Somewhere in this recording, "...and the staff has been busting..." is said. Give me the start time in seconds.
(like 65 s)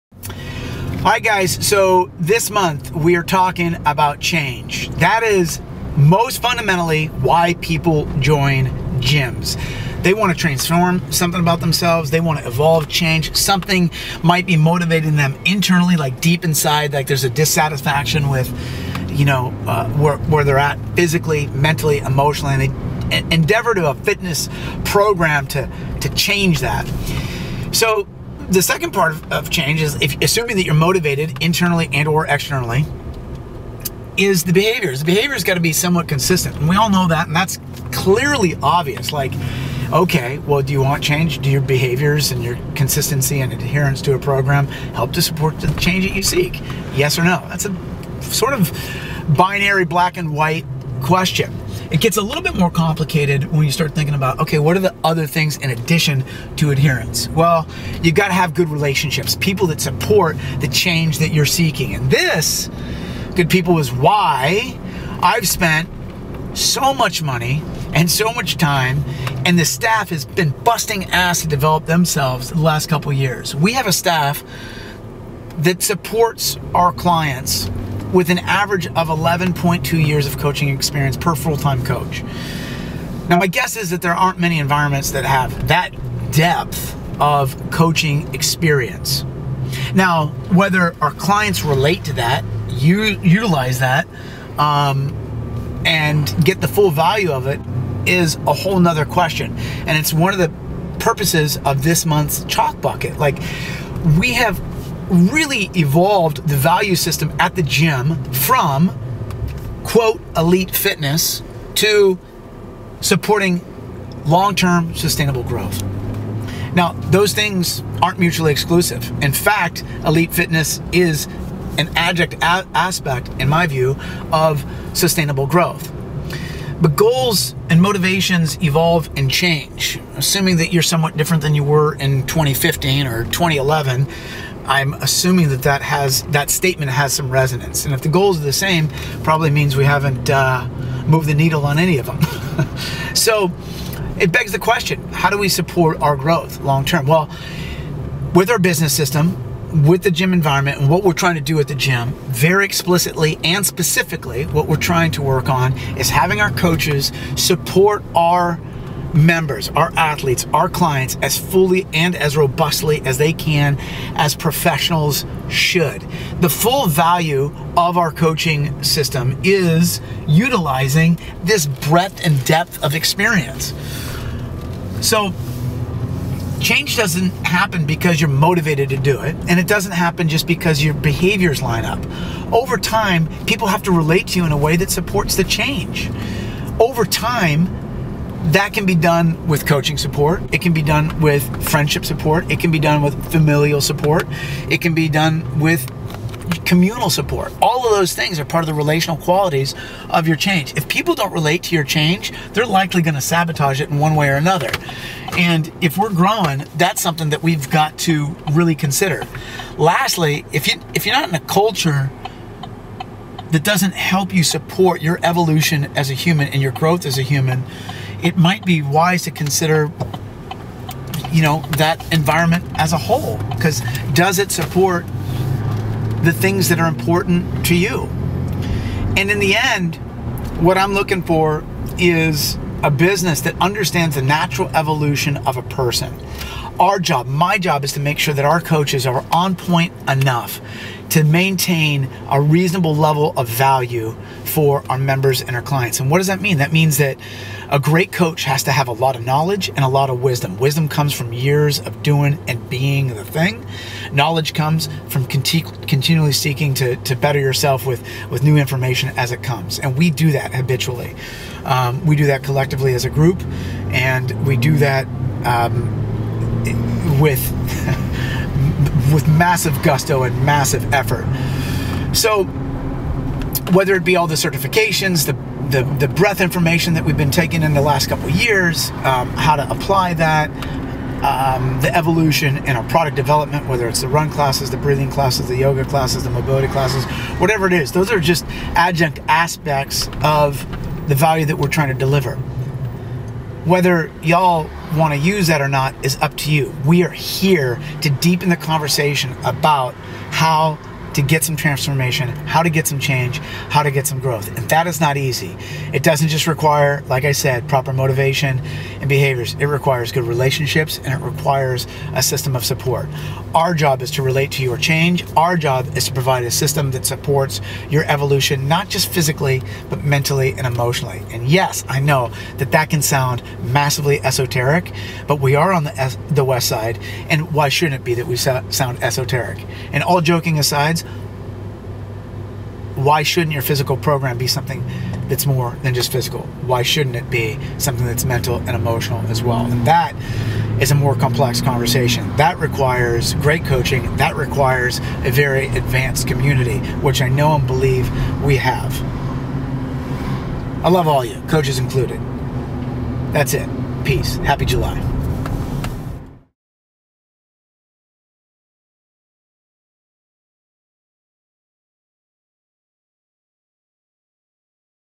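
69 s.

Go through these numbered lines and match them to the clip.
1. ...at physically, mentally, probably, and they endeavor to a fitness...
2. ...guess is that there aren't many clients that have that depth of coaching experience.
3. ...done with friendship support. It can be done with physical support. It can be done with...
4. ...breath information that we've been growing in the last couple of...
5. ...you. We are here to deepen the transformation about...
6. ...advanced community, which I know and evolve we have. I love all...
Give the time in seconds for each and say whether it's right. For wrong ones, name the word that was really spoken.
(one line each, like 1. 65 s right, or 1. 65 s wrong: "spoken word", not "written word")
1. 20 s wrong: "emotionally", not "probably"
2. 83 s wrong: "environments", not "clients"
3. 190 s wrong: "familial", not "physical"
4. 276 s wrong: "taking", not "growing"
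5. 296 s wrong: "conversation", not "transformation"
6. 345 s wrong: "believe", not "evolve".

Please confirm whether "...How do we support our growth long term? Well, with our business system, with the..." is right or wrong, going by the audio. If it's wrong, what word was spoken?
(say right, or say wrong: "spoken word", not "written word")
right.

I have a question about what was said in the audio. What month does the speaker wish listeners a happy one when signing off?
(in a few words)
July.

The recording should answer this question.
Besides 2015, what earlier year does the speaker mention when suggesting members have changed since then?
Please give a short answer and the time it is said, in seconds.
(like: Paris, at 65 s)
2011, at 133 s.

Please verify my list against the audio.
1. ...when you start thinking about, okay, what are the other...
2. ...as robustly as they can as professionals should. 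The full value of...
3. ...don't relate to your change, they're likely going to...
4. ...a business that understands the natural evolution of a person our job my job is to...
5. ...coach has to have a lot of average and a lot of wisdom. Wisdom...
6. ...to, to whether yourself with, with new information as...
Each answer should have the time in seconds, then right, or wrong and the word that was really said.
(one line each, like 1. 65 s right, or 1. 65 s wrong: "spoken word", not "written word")
1. 53 s right
2. 162 s right
3. 201 s right
4. 232 s right
5. 248 s wrong: "knowledge", not "average"
6. 256 s wrong: "better", not "whether".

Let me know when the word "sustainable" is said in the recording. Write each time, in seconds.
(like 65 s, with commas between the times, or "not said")
114 s, 124 s.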